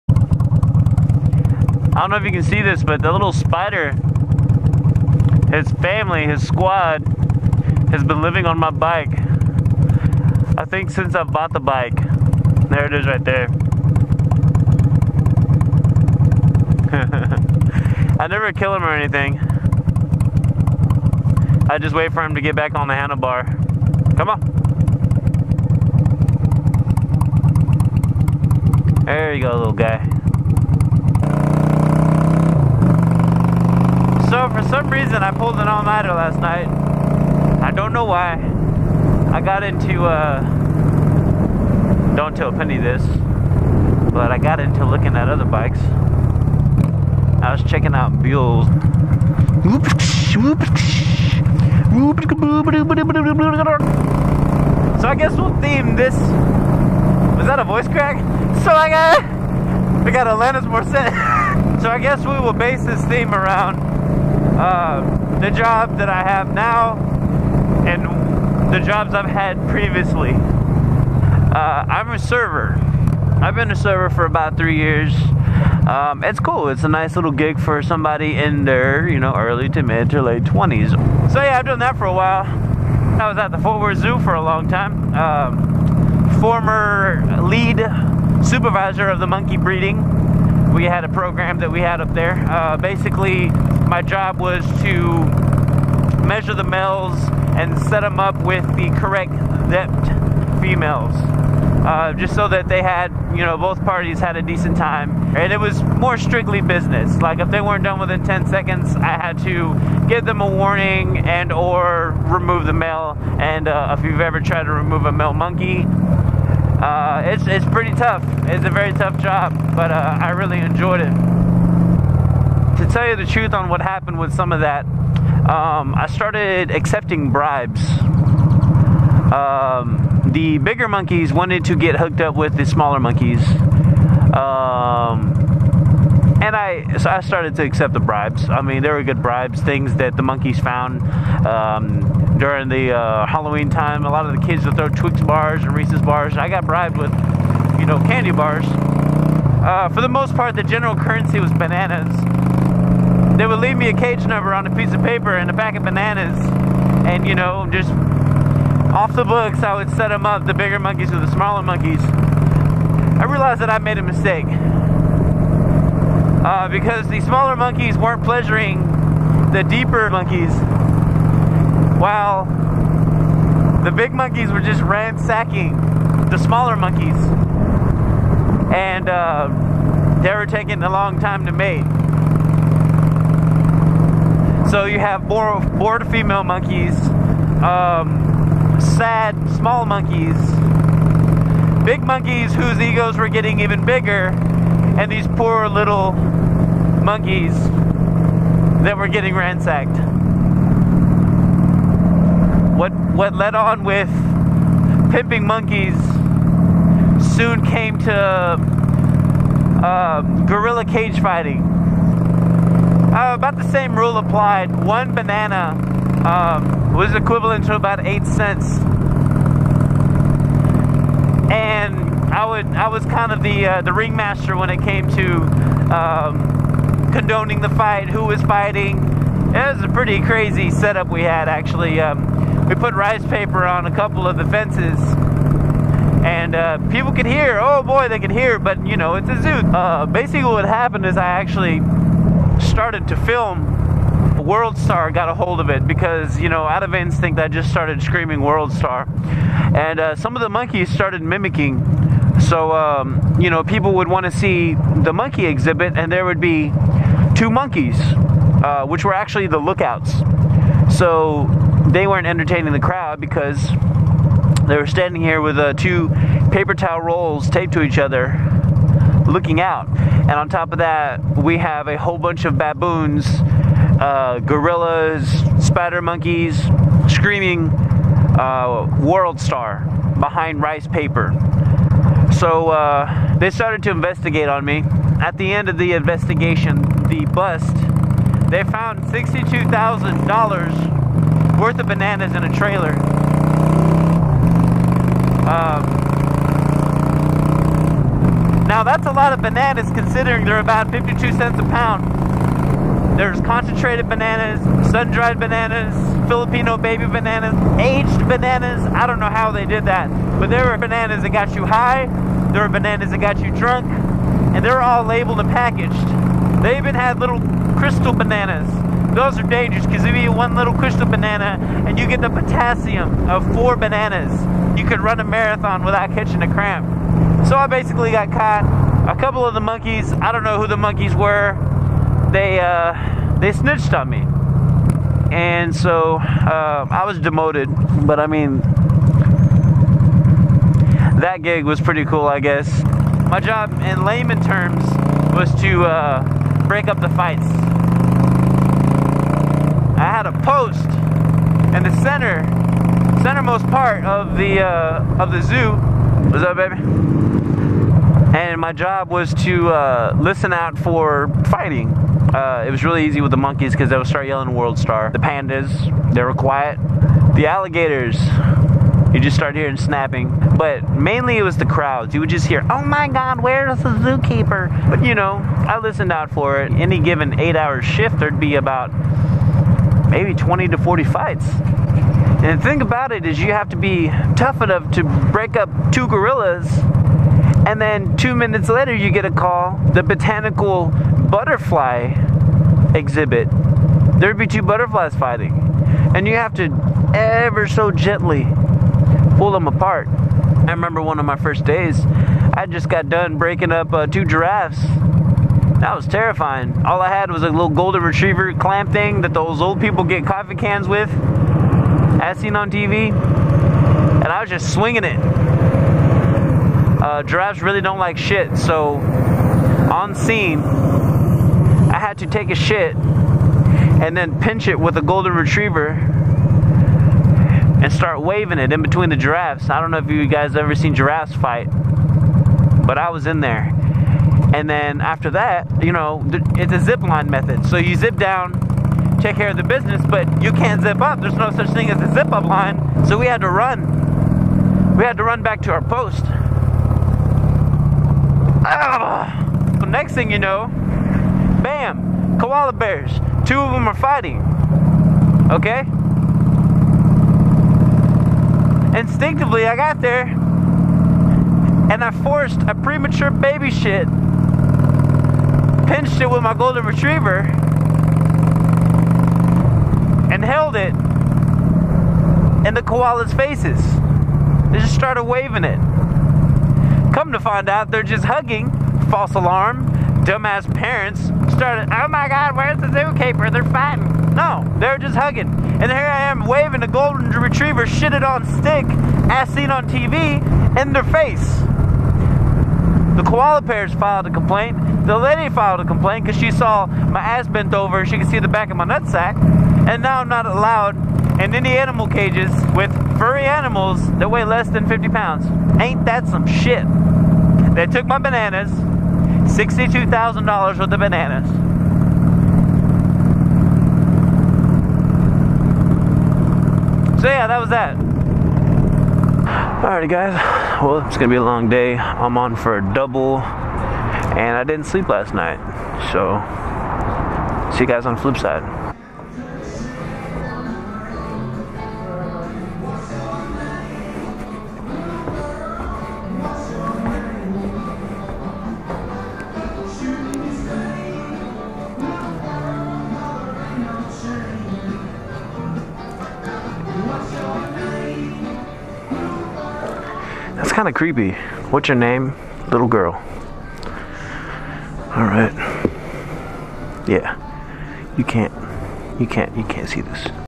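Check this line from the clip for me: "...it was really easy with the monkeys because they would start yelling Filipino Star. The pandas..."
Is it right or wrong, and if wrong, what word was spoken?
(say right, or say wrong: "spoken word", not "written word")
wrong: "World", not "Filipino".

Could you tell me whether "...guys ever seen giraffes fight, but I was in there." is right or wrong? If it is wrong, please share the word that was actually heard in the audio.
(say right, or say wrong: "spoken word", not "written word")
right.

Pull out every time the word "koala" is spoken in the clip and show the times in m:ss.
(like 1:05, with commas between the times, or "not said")
7:32, 7:52, 8:13.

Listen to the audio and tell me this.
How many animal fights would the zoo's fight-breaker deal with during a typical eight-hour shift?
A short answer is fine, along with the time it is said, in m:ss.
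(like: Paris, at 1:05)
20 to 40, at 6:20.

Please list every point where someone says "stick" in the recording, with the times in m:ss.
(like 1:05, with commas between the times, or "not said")
8:08.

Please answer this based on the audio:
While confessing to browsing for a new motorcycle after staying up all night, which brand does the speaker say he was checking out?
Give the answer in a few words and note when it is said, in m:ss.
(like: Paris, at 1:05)
Buells, at 0:48.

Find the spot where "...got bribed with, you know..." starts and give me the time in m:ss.
2:26.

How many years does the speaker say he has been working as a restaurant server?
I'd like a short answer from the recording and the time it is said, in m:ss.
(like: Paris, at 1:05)
3 years, at 1:14.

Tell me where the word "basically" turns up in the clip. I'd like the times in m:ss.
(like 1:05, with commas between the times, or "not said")
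1:32, 4:00, 5:27.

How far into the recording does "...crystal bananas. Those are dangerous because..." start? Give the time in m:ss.
5:17.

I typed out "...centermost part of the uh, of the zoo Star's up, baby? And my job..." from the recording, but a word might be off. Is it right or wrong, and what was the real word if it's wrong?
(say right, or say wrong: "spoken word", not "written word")
wrong: "What", not "Star".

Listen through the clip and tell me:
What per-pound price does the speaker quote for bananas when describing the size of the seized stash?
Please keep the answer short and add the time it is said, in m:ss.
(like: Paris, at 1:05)
52 cents, at 5:00.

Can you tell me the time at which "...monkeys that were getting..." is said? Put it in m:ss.
3:17.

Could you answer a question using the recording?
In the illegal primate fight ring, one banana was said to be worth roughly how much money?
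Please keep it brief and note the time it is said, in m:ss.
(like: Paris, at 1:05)
8 cents, at 3:37.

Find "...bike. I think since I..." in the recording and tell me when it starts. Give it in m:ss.
0:08.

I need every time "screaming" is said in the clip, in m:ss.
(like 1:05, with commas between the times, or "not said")
4:08, 4:37.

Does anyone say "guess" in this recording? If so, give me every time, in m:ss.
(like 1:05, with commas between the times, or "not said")
0:55, 1:01, 5:42.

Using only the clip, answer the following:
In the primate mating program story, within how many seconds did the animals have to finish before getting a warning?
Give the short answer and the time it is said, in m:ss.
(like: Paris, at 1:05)
10 seconds, at 1:48.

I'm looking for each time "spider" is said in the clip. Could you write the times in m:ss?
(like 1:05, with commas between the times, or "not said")
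0:03, 4:35.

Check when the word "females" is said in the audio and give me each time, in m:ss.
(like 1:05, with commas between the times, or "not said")
1:40, 3:06.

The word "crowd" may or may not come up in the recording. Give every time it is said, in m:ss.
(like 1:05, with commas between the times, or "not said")
4:22, 6:11.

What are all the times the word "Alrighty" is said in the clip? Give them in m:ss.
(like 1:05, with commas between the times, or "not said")
8:39.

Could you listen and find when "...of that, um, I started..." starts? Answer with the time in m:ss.
2:04.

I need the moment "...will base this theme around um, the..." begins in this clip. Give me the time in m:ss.
1:02.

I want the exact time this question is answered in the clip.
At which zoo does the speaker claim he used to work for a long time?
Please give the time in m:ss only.
1:23.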